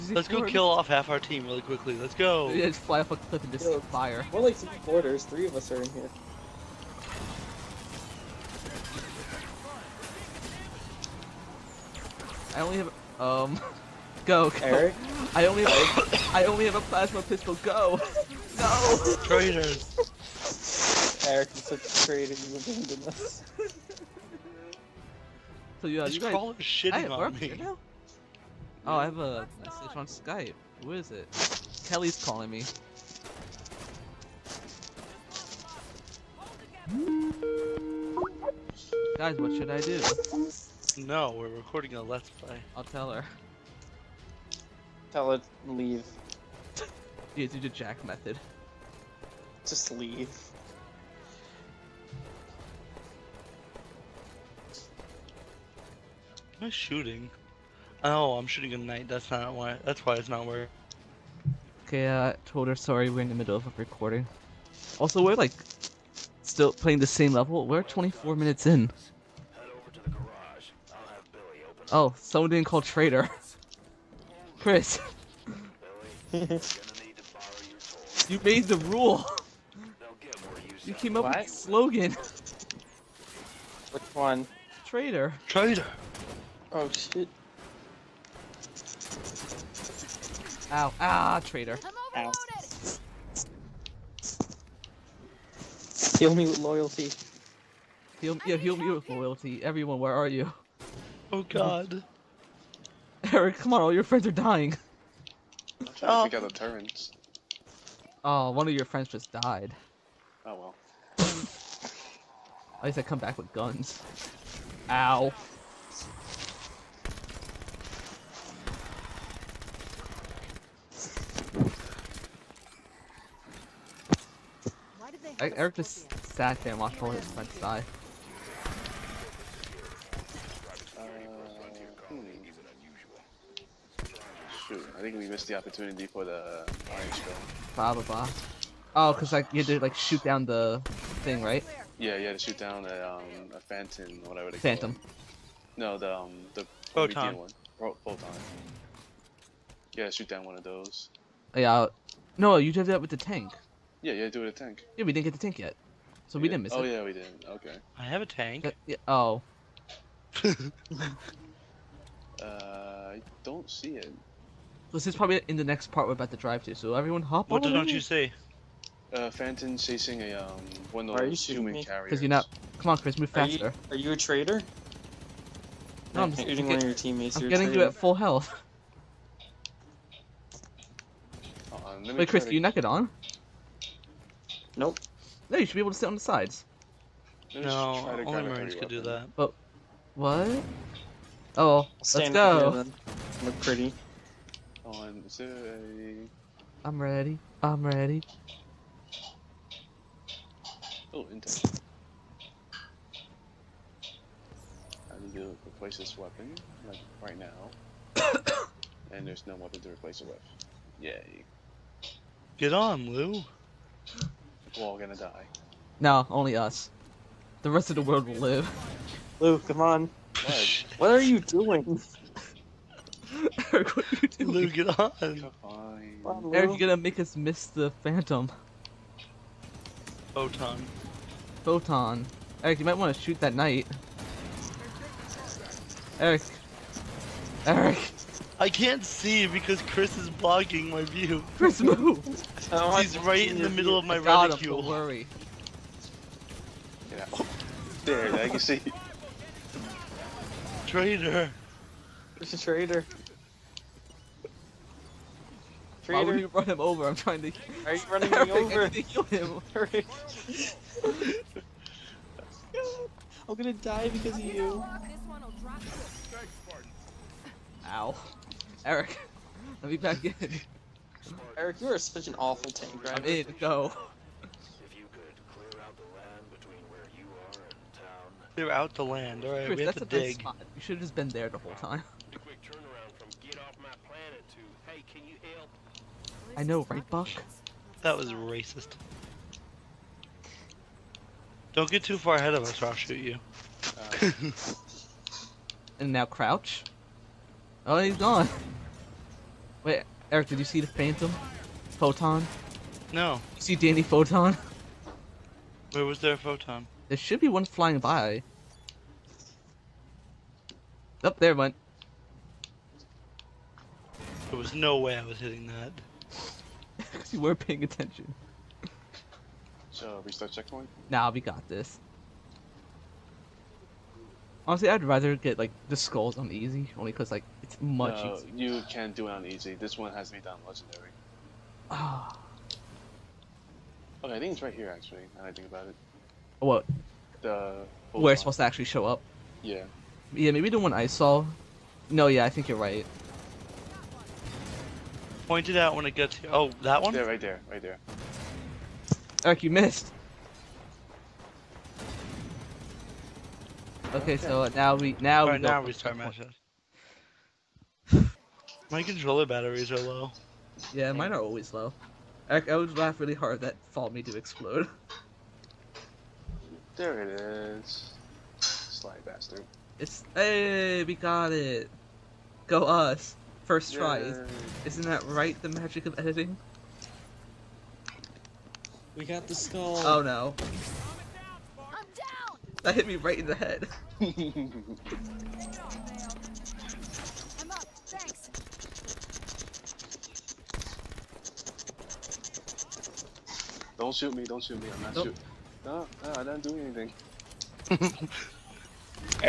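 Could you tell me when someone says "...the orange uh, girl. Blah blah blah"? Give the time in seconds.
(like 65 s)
136 s.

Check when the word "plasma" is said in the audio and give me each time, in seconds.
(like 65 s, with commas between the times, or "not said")
16 s.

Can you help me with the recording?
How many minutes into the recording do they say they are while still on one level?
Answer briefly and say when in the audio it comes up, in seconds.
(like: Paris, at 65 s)
24, at 67 s.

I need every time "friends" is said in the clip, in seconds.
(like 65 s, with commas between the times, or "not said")
104 s, 108 s, 127 s.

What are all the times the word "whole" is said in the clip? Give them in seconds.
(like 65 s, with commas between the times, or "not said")
281 s.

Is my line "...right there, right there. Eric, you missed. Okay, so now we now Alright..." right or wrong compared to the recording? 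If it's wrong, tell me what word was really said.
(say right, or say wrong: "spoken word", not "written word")
right.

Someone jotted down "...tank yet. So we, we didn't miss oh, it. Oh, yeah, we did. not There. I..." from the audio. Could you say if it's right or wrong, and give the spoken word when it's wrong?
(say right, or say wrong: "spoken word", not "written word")
wrong: "Okay", not "There".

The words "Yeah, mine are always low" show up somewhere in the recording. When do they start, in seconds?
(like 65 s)
360 s.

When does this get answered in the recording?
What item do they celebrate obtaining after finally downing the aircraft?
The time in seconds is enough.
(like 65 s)
379 s.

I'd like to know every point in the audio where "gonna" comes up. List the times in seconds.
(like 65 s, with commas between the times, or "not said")
214 s, 226 s, 263 s.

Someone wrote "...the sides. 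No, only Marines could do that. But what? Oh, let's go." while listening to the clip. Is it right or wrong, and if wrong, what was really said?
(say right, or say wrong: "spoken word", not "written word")
right.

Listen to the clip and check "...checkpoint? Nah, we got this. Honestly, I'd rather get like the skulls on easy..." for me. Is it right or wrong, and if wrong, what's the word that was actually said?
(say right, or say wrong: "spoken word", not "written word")
right.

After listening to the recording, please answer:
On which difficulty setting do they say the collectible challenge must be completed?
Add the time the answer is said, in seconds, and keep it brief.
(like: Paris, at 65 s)
Legendary, at 330 s.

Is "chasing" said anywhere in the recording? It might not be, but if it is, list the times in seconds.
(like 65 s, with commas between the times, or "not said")
169 s.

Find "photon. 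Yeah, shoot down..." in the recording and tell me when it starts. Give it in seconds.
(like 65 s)
148 s.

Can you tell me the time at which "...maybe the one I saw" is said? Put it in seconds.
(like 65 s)
340 s.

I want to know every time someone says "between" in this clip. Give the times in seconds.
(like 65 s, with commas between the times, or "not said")
276 s.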